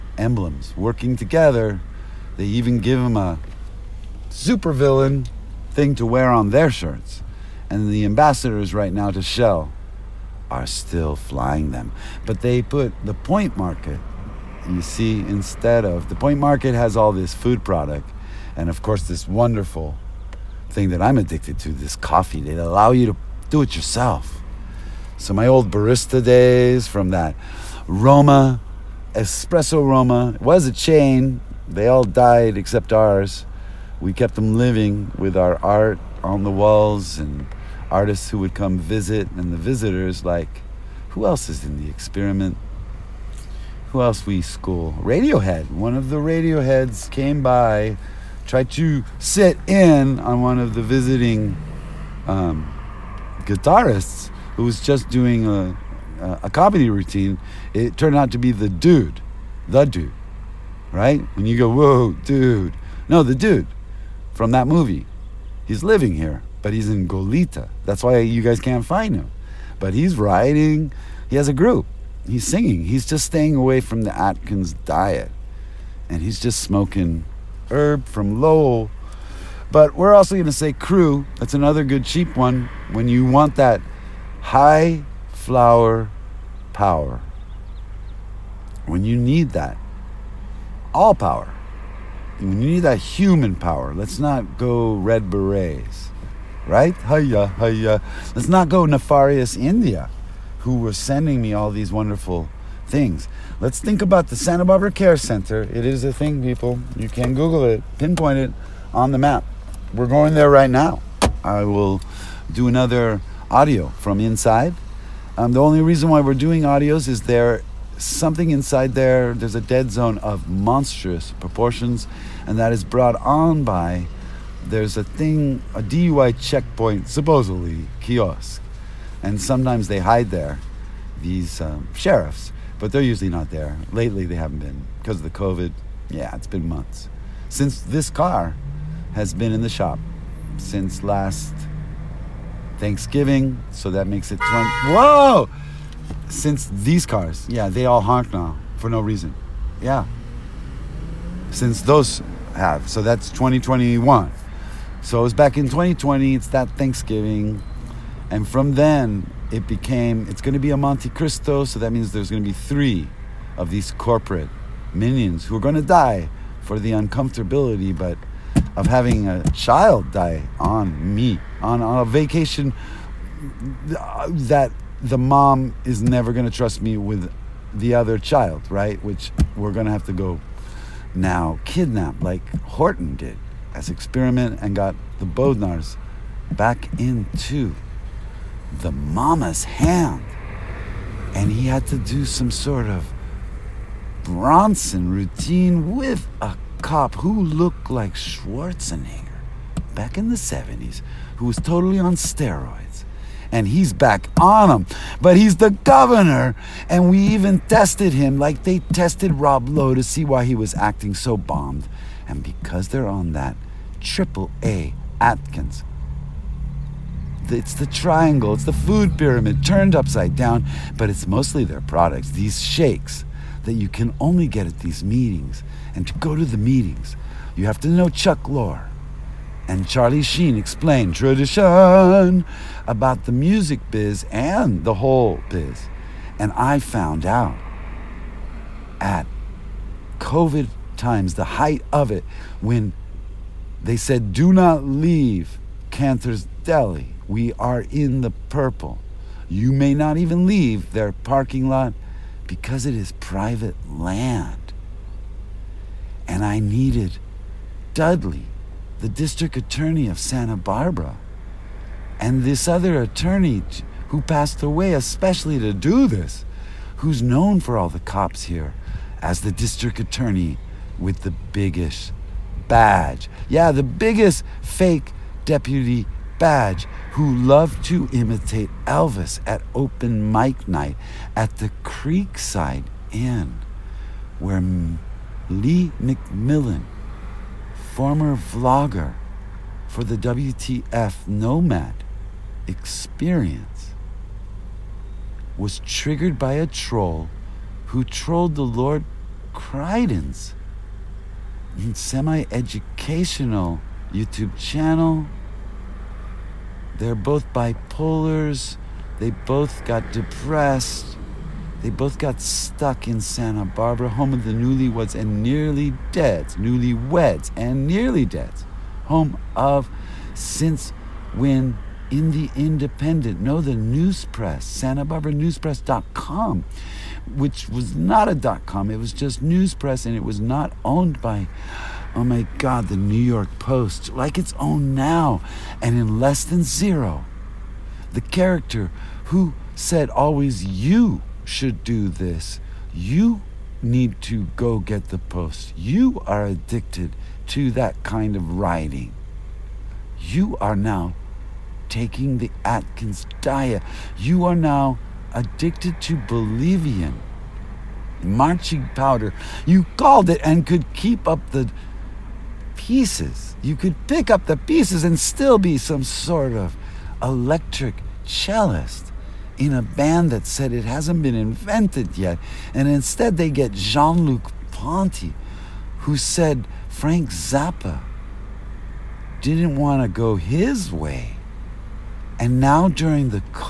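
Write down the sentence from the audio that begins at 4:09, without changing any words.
You may not even leave their parking lot because it is private land.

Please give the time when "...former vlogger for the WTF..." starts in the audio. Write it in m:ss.
4:47.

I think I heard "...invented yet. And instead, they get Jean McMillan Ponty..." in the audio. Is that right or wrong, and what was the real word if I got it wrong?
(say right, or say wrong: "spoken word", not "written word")
wrong: "Luc", not "McMillan".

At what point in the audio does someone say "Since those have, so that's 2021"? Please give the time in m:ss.
2:31.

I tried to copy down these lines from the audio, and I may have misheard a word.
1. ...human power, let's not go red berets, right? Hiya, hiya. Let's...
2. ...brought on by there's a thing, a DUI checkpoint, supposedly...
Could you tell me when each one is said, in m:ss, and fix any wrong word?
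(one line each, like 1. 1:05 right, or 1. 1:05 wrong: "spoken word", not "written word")
1. 1:32 right
2. 2:02 right.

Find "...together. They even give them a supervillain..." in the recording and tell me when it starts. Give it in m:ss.
0:01.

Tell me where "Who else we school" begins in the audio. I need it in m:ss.
0:43.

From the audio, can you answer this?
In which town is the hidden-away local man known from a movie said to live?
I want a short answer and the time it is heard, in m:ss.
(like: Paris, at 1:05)
Goleta, at 1:07.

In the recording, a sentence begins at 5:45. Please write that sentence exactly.
You are addicted to that kind of writing.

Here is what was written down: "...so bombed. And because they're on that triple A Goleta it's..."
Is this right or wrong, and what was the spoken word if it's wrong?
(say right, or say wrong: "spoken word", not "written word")
wrong: "Atkins", not "Goleta".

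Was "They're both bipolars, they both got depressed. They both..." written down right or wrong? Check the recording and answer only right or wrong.
right.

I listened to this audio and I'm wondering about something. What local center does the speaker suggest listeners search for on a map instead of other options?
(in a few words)
Santa Barbara Care Center.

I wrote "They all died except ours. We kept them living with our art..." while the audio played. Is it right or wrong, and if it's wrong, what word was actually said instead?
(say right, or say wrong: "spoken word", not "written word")
right.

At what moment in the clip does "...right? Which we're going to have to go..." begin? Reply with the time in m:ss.
2:58.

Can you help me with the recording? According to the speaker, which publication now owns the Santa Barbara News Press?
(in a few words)
New York Post.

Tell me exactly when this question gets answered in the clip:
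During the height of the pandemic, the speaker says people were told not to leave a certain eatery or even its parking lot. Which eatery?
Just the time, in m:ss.
4:05.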